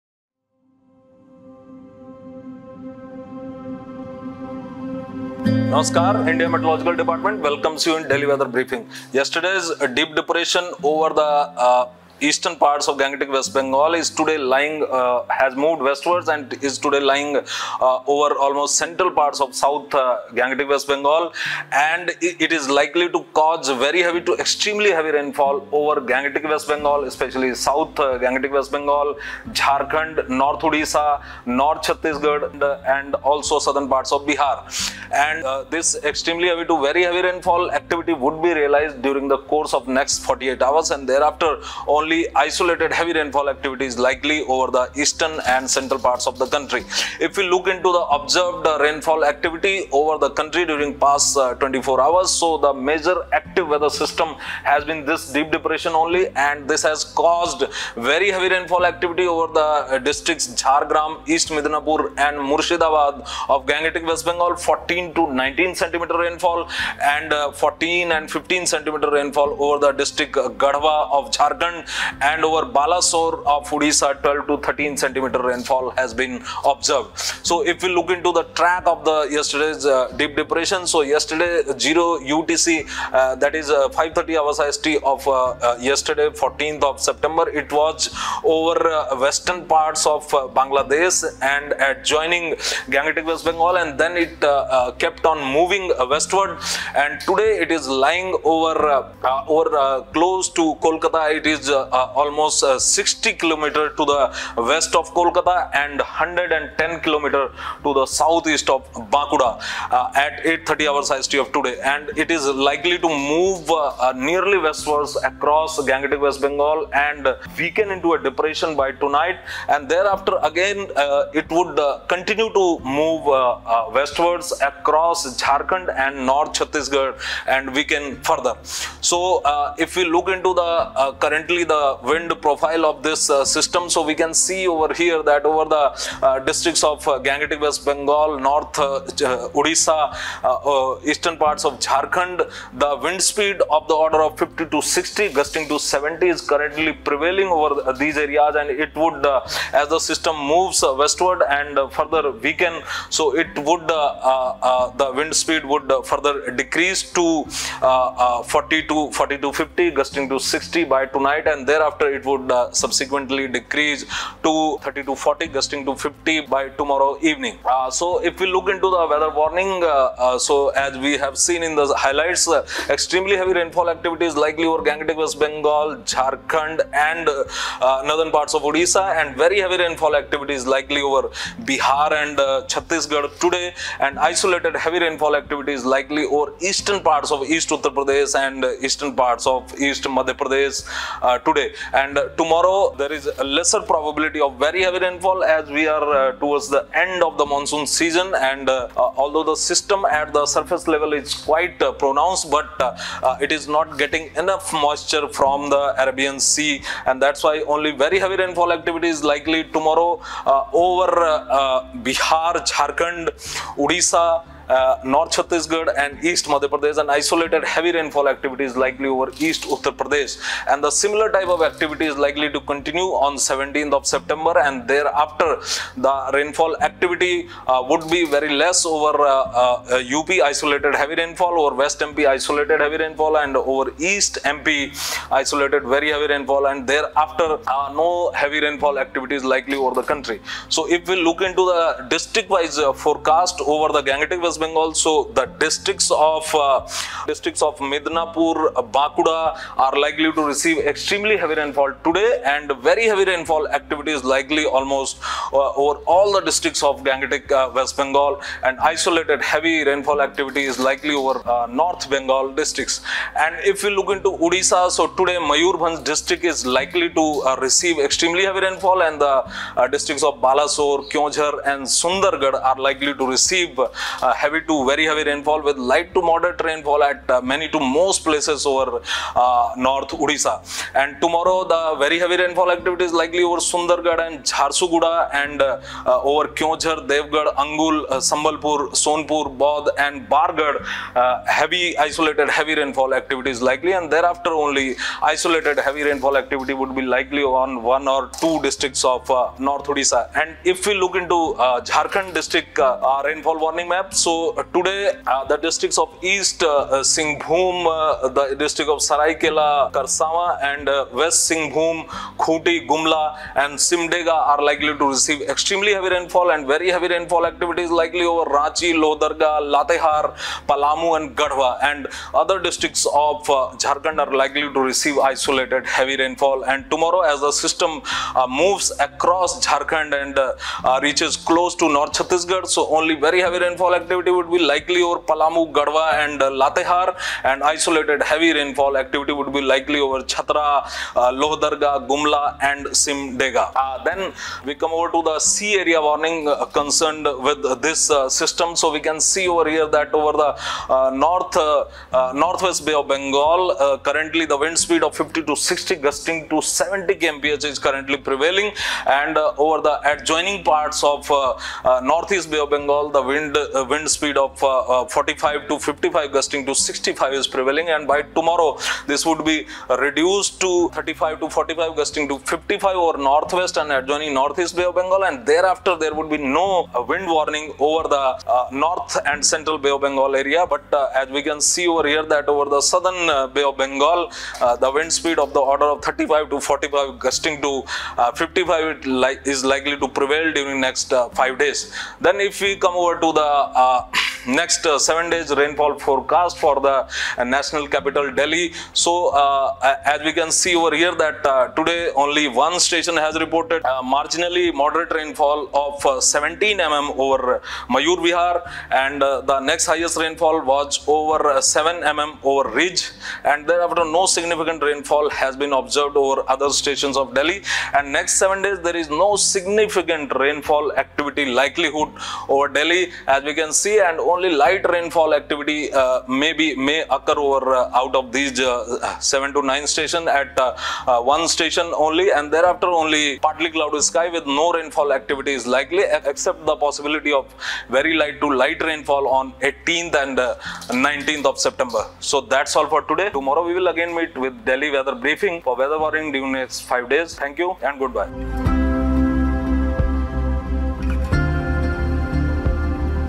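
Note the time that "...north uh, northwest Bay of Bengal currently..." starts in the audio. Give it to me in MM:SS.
05:51.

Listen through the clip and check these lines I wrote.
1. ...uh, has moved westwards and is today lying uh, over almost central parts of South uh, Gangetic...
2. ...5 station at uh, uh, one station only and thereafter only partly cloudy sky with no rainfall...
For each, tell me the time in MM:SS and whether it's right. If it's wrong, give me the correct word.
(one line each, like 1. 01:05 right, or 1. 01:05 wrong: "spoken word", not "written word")
1. 00:14 right
2. 07:09 wrong: "9", not "5".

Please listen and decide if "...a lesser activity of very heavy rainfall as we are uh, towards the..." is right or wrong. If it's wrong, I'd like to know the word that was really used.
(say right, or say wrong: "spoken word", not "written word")
wrong: "probability", not "activity".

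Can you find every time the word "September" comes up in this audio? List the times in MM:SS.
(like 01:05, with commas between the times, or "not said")
01:27, 03:44, 07:21.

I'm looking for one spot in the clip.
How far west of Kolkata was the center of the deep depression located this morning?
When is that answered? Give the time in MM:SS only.
01:42.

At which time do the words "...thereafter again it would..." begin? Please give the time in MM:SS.
01:59.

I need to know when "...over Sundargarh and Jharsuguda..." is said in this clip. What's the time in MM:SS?
04:43.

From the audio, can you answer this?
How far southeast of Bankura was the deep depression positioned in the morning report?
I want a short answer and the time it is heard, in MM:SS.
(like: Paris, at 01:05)
110 kilometers, at 01:45.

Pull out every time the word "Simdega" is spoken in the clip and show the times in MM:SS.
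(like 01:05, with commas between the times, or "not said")
05:13, 05:42.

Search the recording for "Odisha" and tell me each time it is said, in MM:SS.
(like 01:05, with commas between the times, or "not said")
00:30, 01:13, 02:19, 02:58, 03:33, 04:24, 04:40, 04:59.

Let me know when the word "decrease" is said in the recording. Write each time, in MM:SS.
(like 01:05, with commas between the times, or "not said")
02:36, 02:43.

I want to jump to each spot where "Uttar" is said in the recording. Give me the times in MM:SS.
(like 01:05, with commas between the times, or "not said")
03:07, 03:39.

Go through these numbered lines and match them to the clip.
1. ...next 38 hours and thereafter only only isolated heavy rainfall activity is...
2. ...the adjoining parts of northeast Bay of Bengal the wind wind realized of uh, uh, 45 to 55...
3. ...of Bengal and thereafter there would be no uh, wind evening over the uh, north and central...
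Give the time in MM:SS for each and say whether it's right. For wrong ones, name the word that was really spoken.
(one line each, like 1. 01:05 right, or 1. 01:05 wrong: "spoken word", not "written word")
1. 00:39 wrong: "48", not "38"
2. 05:59 wrong: "speed", not "realized"
3. 06:14 wrong: "warning", not "evening".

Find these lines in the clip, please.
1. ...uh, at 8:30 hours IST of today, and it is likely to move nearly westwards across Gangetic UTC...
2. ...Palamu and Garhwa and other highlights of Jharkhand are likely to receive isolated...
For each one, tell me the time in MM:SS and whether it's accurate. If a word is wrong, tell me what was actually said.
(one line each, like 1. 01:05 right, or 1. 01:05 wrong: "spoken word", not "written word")
1. 01:49 wrong: "West", not "UTC"
2. 05:20 wrong: "districts", not "highlights".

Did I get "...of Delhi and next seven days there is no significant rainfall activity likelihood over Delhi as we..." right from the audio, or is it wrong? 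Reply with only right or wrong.
right.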